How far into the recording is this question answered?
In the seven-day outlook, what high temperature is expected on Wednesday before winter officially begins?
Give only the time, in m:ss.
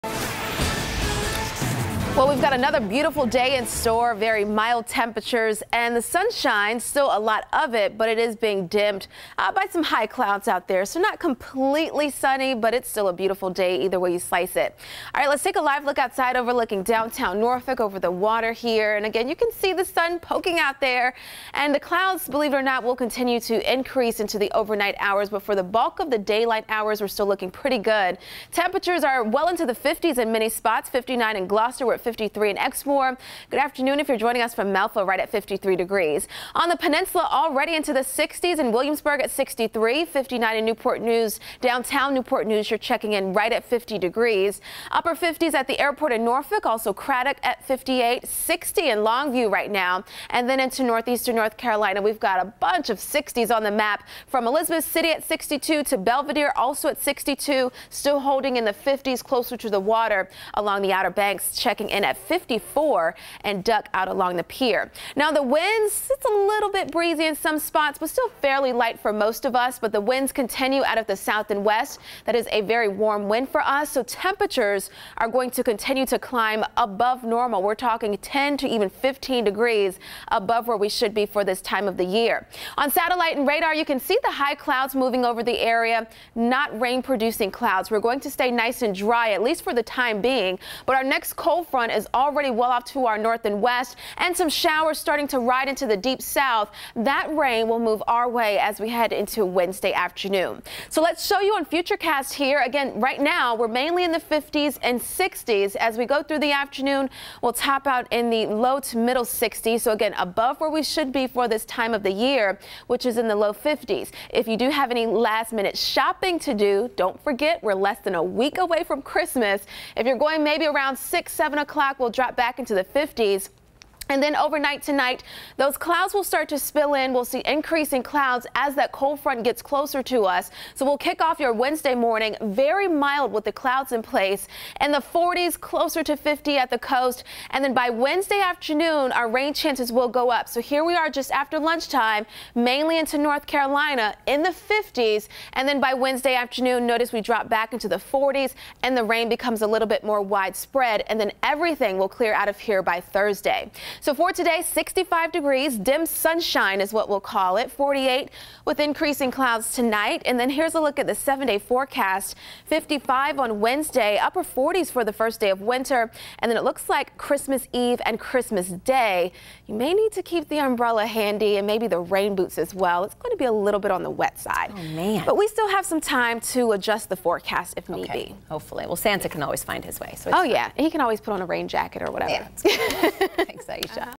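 2:42.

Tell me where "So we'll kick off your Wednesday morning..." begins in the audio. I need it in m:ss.
2:10.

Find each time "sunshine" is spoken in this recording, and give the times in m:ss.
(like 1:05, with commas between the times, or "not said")
0:06, 2:36.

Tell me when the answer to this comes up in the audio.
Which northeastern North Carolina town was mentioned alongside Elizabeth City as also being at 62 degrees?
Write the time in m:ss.
0:55.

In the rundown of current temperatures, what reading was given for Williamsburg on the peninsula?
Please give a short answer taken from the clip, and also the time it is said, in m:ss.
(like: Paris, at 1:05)
63, at 0:39.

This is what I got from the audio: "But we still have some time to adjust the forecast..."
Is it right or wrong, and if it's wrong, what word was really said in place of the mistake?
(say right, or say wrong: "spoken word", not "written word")
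right.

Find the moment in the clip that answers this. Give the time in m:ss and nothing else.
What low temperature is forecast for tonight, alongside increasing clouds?
2:37.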